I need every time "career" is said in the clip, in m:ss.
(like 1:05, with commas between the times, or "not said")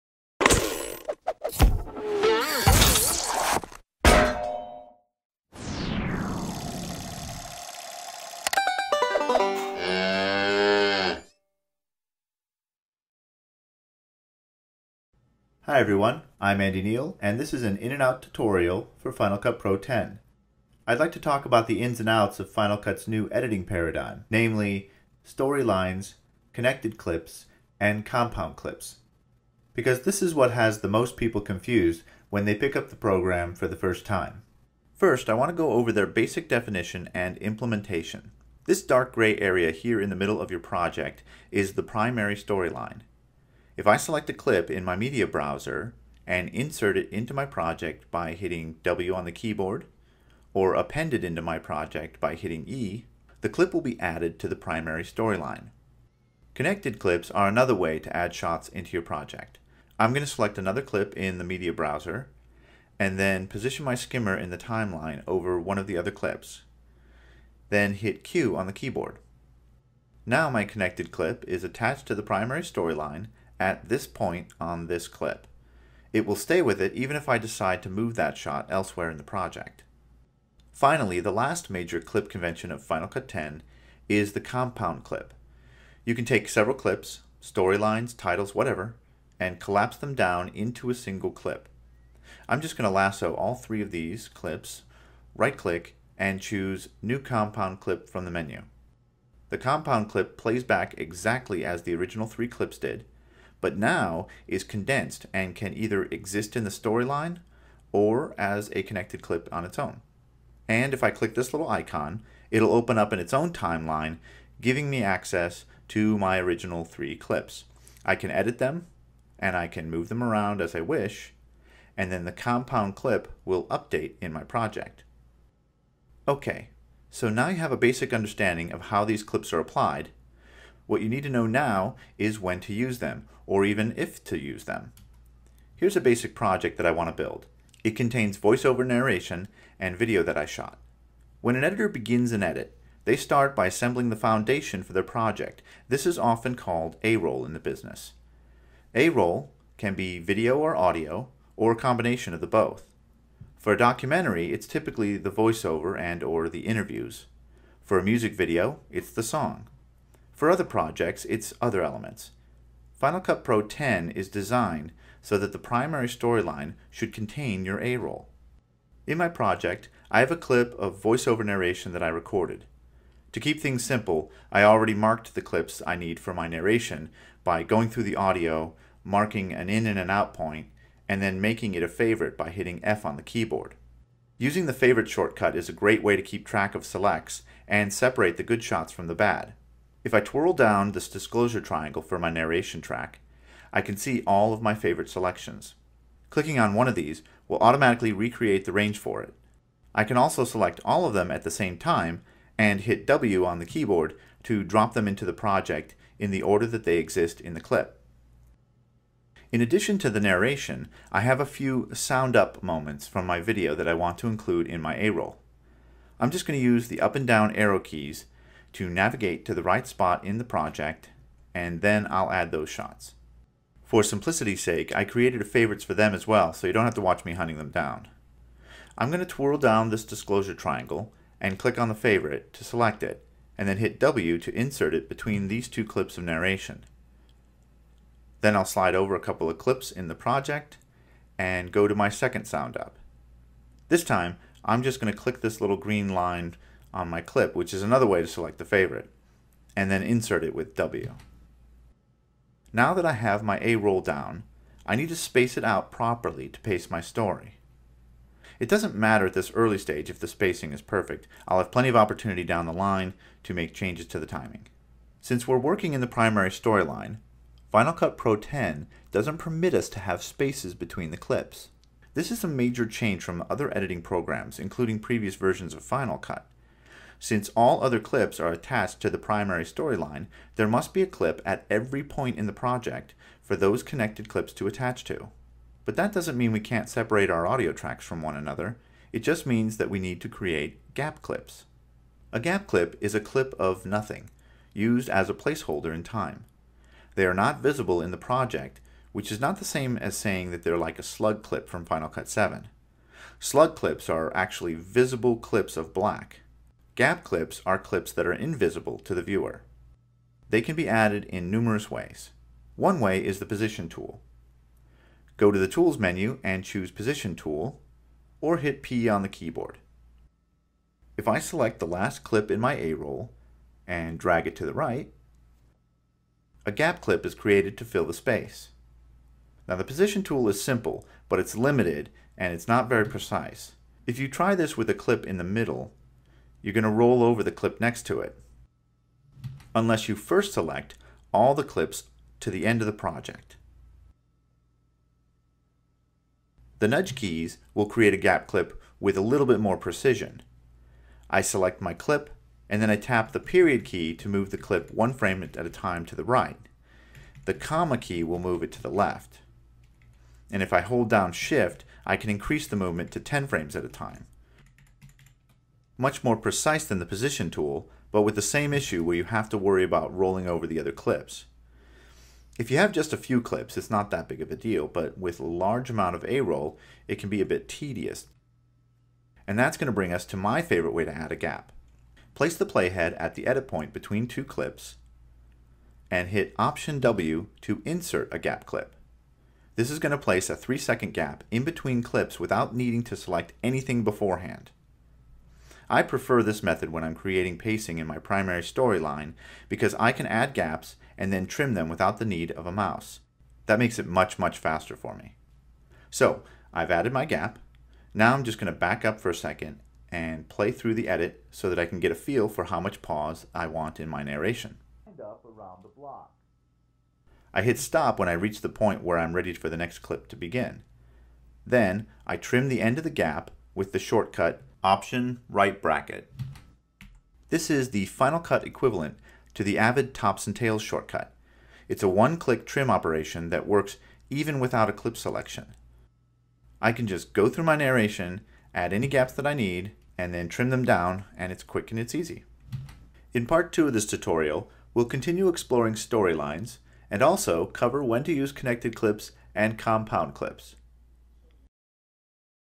not said.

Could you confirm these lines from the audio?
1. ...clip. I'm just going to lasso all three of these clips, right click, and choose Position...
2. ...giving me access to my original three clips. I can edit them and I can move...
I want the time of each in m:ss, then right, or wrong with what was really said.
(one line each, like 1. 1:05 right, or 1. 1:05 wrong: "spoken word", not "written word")
1. 1:31 wrong: "New", not "Position"
2. 1:54 right.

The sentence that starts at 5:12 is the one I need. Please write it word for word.
One way is the position tool.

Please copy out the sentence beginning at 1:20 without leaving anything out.
Finally, the last major clip convention of Final Cut 10 is the compound clip.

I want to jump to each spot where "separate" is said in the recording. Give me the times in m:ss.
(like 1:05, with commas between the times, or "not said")
3:07, 4:46.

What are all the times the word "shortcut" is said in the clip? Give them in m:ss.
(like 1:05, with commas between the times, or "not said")
3:05, 7:03, 7:10.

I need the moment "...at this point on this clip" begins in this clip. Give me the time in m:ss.
1:13.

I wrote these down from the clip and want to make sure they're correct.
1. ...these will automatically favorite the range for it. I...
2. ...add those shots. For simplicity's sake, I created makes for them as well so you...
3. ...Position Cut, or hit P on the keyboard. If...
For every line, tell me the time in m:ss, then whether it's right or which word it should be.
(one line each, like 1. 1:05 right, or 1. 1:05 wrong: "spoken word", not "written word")
1. 3:16 wrong: "recreate", not "favorite"
2. 3:42 wrong: "favorites", not "makes"
3. 5:16 wrong: "Tool", not "Cut".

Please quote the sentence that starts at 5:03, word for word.
Slug clips are actually visible clips of black.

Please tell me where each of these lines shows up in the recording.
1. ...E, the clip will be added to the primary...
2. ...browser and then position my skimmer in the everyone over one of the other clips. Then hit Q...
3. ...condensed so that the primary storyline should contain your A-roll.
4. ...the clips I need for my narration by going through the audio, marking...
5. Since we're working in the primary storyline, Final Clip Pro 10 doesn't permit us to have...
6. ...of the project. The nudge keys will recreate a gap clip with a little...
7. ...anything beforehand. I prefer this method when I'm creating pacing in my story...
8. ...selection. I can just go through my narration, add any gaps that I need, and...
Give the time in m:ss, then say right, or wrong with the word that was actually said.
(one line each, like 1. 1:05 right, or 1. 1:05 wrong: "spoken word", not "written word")
1. 0:52 right
2. 1:01 wrong: "timeline", not "everyone"
3. 2:44 wrong: "designed", not "condensed"
4. 2:55 right
5. 4:25 wrong: "Cut", not "Clip"
6. 5:42 wrong: "create", not "recreate"
7. 6:33 wrong: "primary", not "story"
8. 7:15 right.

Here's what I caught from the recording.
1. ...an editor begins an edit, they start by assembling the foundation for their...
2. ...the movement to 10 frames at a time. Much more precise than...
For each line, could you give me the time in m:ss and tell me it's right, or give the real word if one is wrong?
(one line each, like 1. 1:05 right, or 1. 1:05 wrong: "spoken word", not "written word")
1. 2:21 right
2. 6:02 right.